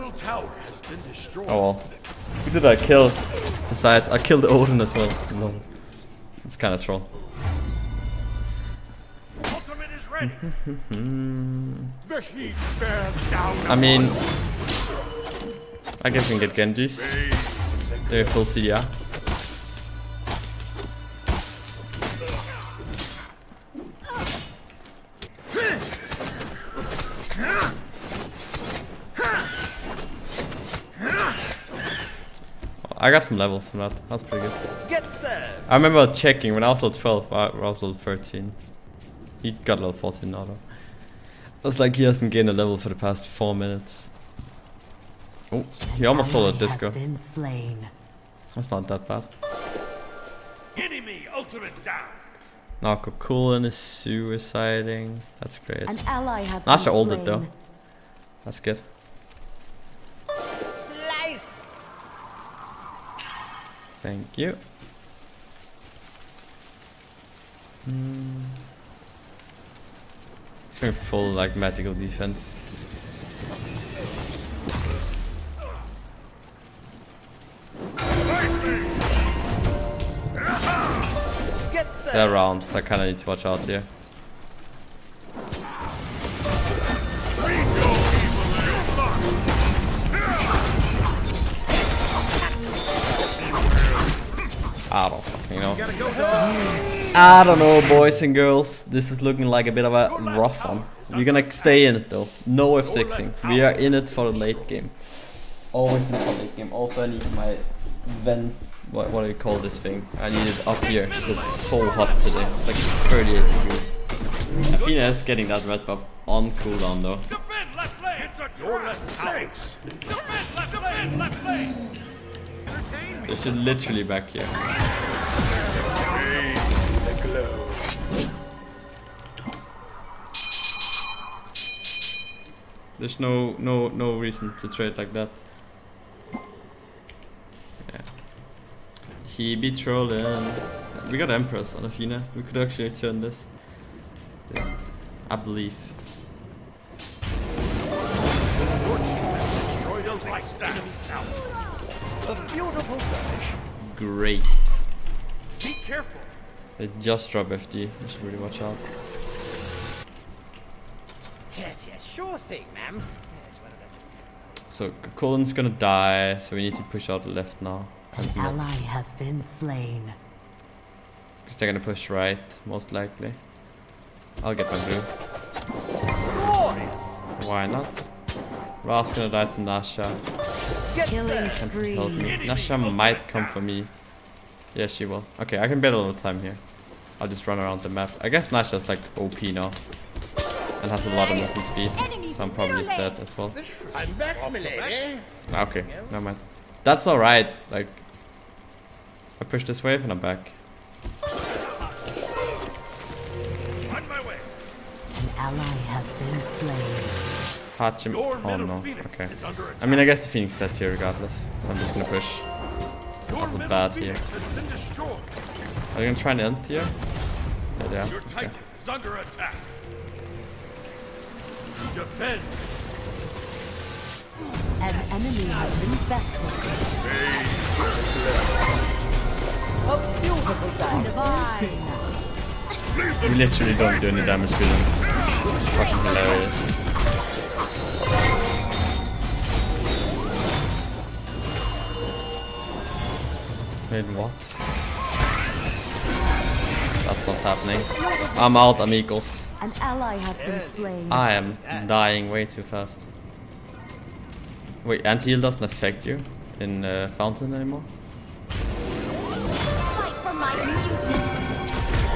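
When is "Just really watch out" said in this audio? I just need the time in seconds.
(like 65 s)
158 s.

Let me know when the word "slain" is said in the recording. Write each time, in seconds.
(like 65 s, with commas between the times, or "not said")
47 s, 169 s, 250 s.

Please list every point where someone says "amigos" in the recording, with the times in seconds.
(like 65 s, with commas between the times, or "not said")
248 s.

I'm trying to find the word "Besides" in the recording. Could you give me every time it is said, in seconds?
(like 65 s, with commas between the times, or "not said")
3 s.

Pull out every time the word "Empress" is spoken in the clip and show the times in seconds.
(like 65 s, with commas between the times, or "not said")
141 s.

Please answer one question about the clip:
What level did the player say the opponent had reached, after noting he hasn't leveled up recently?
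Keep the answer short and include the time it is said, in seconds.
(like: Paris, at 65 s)
14, at 39 s.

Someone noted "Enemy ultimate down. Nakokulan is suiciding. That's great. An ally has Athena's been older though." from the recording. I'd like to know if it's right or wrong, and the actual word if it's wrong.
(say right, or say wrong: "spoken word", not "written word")
wrong: "That", not "Athena".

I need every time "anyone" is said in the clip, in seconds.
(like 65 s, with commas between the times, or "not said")
not said.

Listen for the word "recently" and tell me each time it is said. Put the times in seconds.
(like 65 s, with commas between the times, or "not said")
not said.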